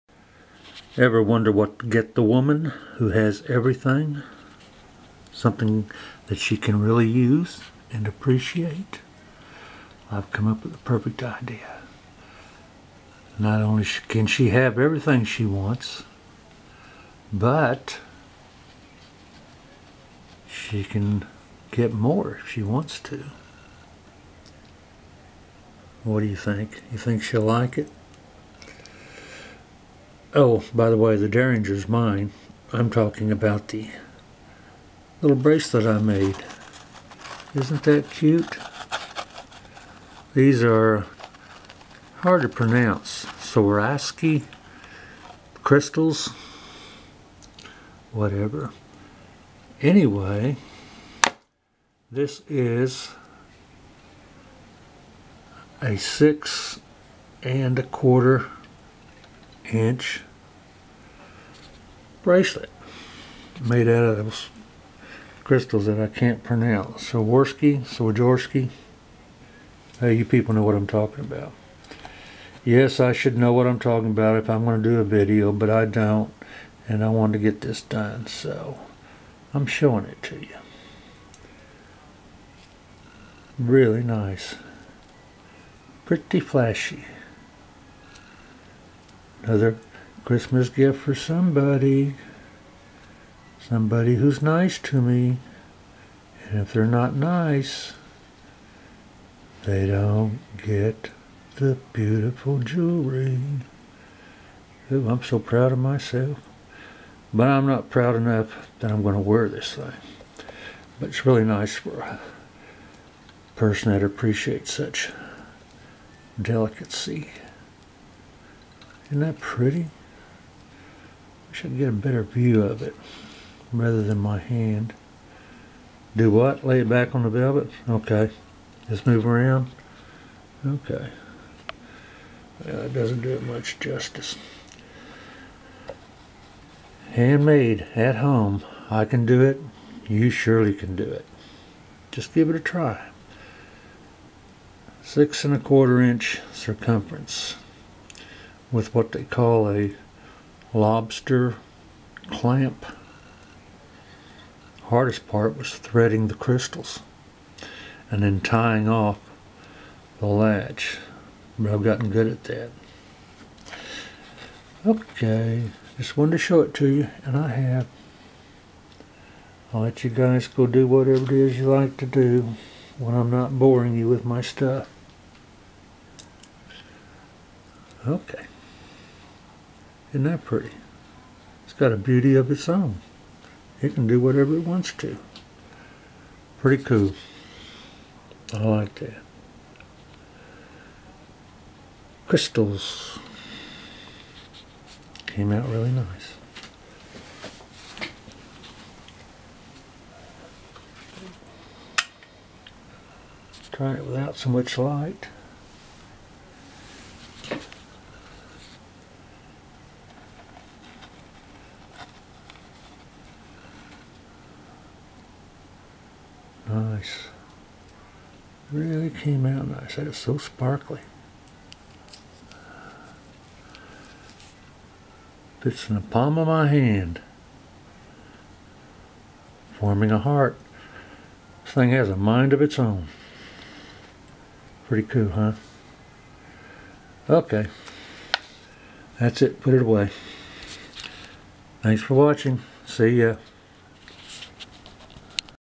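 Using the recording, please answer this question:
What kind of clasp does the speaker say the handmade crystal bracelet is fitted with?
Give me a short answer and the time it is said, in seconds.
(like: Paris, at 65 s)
lobster clamp, at 150 s.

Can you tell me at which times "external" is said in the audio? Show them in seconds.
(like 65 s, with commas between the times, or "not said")
not said.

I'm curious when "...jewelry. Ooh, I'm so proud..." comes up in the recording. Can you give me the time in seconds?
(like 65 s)
102 s.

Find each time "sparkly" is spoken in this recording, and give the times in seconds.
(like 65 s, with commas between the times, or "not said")
220 s.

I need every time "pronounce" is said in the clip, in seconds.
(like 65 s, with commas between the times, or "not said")
42 s, 66 s.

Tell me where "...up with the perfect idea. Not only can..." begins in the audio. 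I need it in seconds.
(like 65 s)
10 s.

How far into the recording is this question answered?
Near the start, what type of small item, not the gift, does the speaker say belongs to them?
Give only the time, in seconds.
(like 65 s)
31 s.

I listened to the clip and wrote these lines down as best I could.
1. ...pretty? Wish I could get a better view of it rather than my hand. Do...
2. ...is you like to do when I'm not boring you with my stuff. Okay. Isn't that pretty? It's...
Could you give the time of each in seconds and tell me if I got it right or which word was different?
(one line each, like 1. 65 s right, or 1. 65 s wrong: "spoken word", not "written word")
1. 119 s right
2. 171 s right.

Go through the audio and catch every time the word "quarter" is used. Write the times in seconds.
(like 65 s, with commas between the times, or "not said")
57 s, 145 s.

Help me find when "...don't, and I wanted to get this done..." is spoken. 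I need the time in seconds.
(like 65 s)
75 s.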